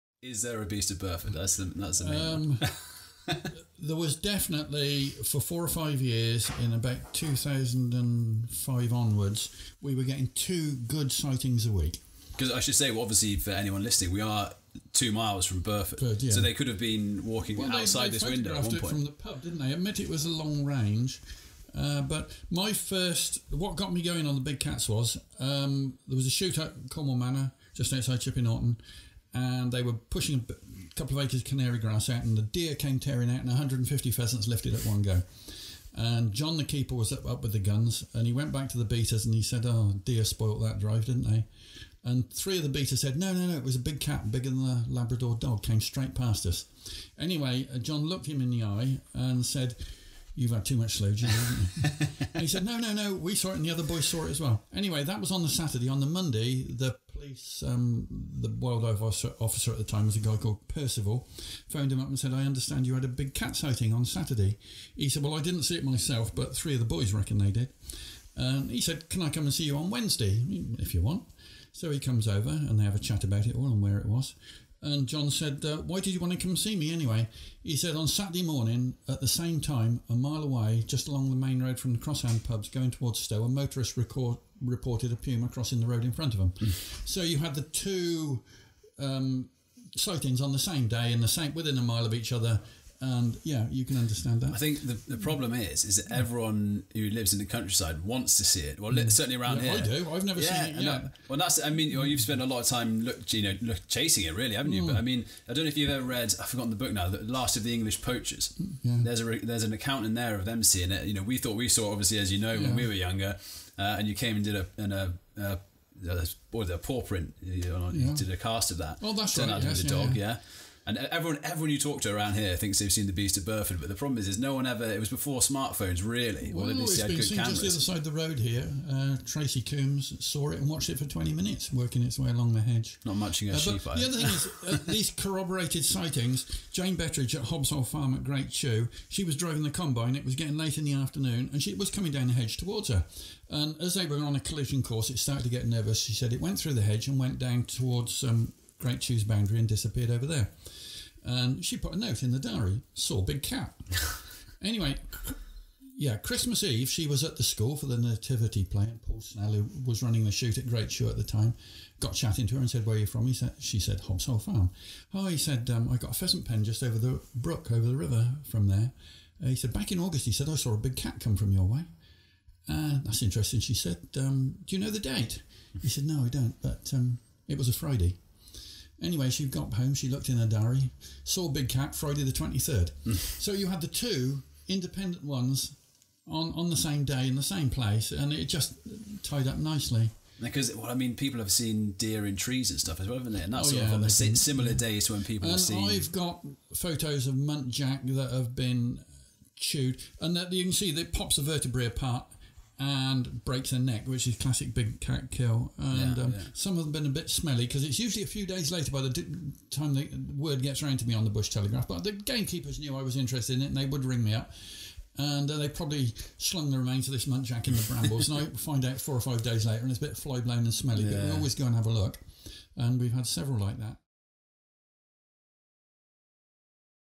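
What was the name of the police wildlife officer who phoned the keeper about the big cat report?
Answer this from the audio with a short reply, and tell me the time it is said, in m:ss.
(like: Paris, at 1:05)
Percival, at 1:00.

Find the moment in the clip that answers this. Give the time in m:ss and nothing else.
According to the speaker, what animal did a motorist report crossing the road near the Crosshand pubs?
1:25.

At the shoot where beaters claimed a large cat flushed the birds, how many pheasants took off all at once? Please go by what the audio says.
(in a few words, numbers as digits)
150.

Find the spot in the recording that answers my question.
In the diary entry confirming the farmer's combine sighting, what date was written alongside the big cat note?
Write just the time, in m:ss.
3:01.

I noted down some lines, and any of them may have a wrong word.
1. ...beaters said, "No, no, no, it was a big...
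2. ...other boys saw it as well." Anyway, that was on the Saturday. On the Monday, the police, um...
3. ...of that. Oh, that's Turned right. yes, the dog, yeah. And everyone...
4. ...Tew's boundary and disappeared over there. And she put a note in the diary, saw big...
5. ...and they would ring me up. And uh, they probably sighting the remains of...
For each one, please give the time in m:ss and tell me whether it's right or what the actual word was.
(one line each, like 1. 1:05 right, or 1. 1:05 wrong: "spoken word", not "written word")
1. 0:42 right
2. 0:53 right
3. 1:58 right
4. 2:28 right
5. 3:33 wrong: "slung", not "sighting".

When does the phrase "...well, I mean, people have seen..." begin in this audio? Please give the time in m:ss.
3:10.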